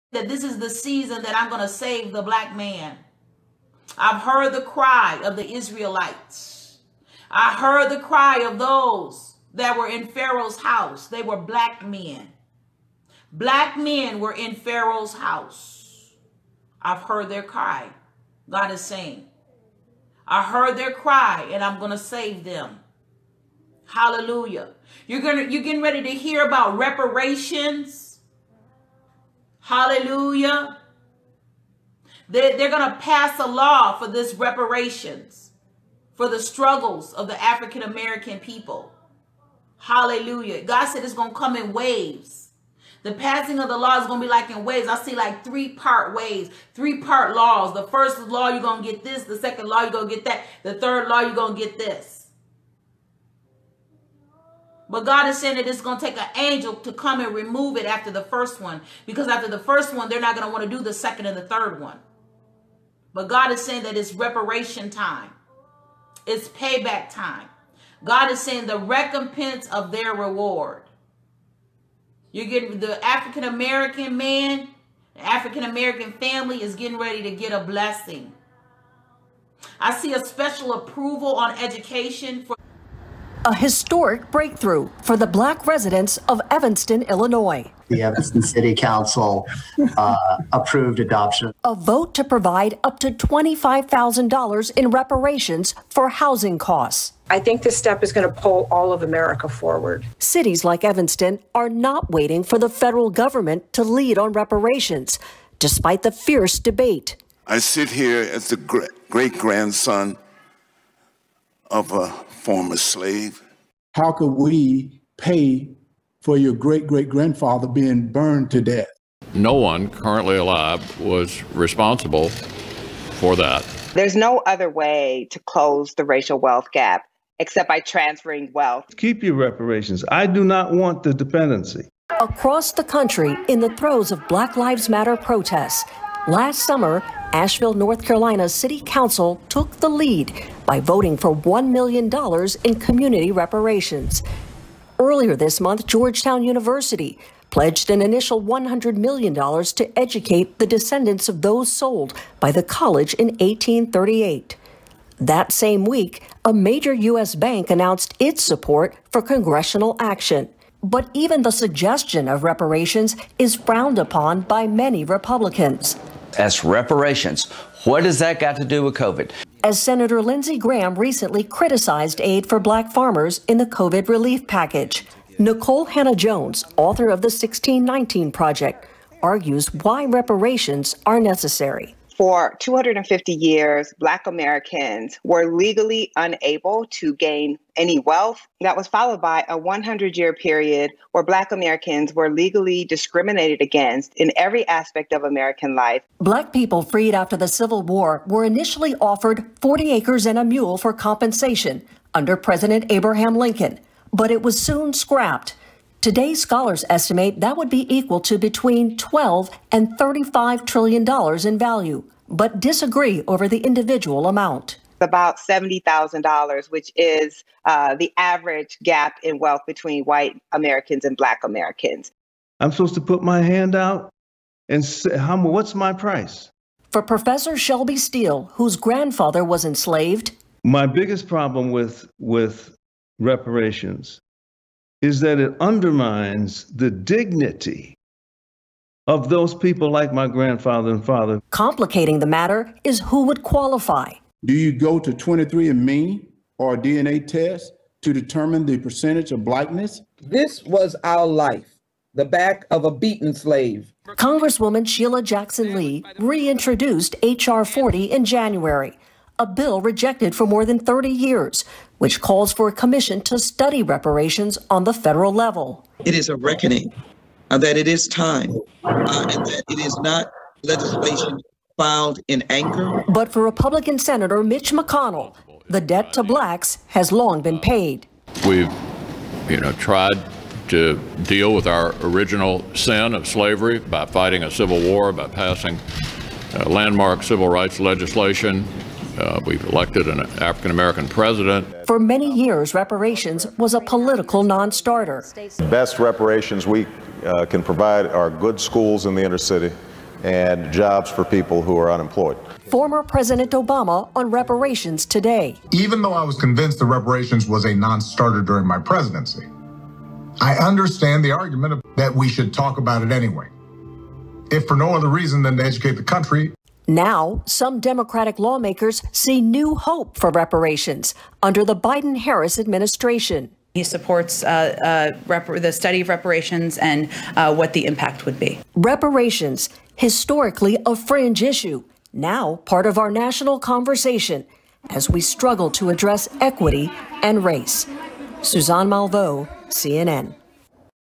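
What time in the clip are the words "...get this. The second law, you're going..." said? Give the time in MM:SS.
00:48.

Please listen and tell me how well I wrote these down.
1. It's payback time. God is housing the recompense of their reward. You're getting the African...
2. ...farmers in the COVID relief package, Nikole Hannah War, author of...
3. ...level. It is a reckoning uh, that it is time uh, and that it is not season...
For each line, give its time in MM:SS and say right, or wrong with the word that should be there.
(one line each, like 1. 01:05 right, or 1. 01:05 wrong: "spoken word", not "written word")
1. 01:06 wrong: "saying", not "housing"
2. 02:52 wrong: "Jones", not "War"
3. 04:25 wrong: "legislation", not "season".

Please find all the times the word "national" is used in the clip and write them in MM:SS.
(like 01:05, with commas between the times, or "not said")
05:33.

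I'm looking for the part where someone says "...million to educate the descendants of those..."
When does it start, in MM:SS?
02:28.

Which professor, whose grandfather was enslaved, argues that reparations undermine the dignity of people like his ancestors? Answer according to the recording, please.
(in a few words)
Shelby Steele.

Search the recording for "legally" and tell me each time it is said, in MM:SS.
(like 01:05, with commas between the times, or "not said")
03:05, 03:12.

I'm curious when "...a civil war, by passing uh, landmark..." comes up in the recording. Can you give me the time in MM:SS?
04:44.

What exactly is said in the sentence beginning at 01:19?
I see a special approval on education for a historic breakthrough for the black residents of Evanston, Illinois.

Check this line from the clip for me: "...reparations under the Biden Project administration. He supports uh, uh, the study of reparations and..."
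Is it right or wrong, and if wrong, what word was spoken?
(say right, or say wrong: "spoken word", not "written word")
wrong: "Harris", not "Project".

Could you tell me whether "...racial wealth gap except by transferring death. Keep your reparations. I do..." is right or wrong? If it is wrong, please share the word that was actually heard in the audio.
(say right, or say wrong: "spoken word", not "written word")
wrong: "wealth", not "death".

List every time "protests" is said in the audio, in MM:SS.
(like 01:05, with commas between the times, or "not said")
02:15.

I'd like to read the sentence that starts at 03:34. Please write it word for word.
About $70,000, which is uh, the average gap in wealth between white Americans and black Americans.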